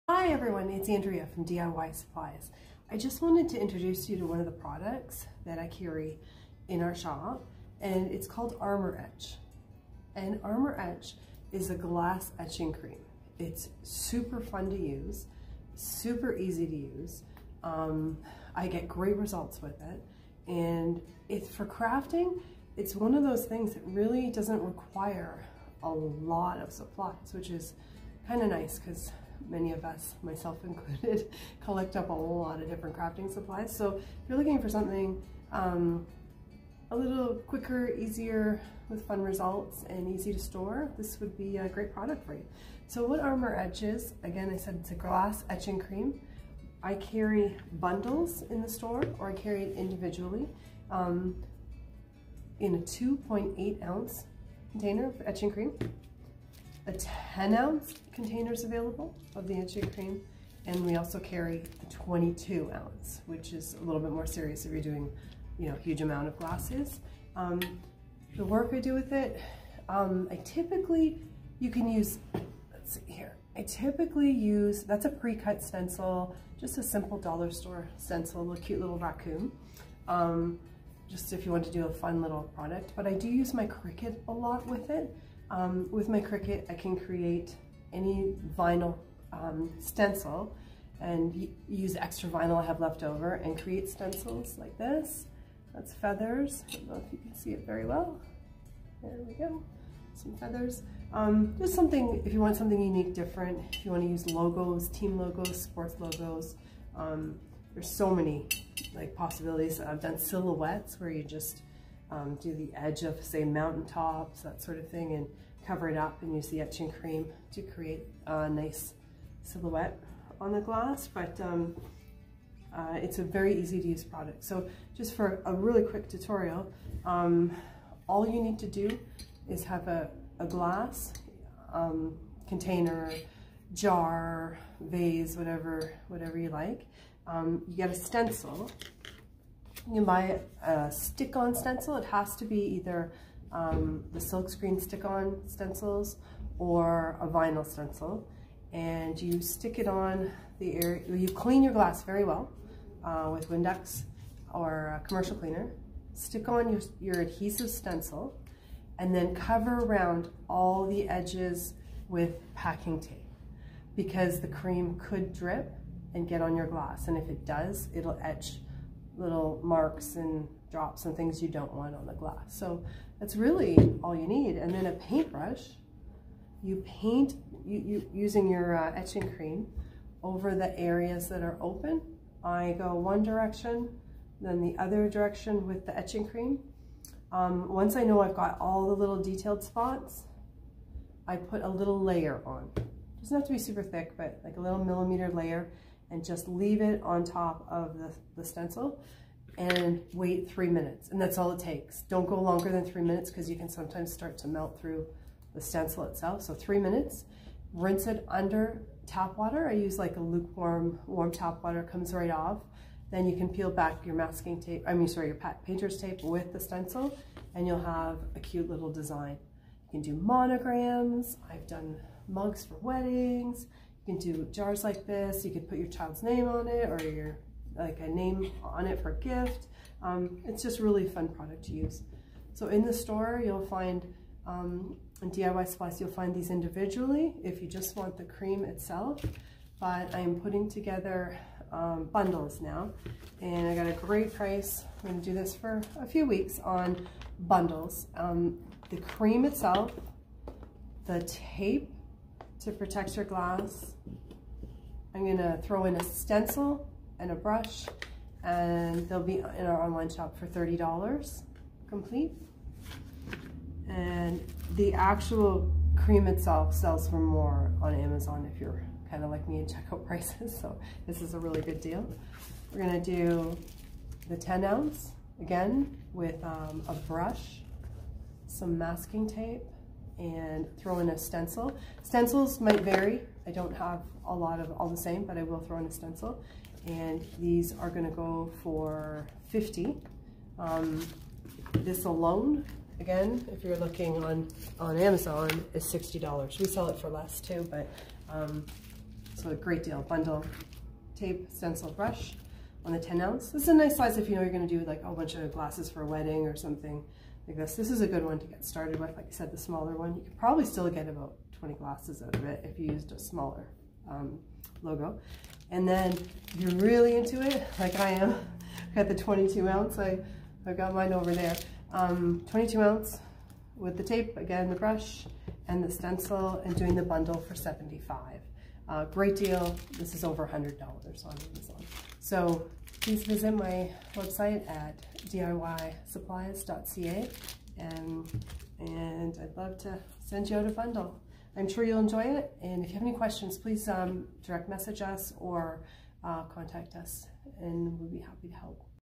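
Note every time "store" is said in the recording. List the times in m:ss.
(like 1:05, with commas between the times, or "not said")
0:40, 0:48, 1:17, 3:52.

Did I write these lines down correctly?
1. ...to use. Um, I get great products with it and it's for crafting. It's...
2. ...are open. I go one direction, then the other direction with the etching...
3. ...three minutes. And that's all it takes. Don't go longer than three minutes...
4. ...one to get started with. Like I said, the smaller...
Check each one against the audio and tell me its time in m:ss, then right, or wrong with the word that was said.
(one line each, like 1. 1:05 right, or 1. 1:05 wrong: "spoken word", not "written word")
1. 0:16 wrong: "results", not "products"
2. 3:01 right
3. 3:20 right
4. 5:08 right.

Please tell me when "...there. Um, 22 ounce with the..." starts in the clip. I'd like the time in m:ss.
5:21.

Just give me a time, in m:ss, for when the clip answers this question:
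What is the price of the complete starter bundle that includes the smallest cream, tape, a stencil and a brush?
4:20.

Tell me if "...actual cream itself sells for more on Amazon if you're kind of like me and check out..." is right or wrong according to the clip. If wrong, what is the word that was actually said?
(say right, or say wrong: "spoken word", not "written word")
right.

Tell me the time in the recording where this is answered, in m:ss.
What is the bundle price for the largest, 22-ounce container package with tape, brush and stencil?
5:27.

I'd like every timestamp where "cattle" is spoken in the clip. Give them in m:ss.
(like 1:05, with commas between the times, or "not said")
not said.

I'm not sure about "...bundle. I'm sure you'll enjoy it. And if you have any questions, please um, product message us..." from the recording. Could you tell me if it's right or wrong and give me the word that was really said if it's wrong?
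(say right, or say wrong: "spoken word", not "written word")
wrong: "direct", not "product".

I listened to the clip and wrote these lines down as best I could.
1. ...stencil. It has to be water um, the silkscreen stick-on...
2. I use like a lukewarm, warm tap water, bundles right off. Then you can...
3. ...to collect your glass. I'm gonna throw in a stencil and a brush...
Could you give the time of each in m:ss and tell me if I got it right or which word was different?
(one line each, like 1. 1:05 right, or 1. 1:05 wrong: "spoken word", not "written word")
1. 2:21 wrong: "either", not "water"
2. 3:29 wrong: "comes", not "bundles"
3. 4:12 wrong: "protect", not "collect".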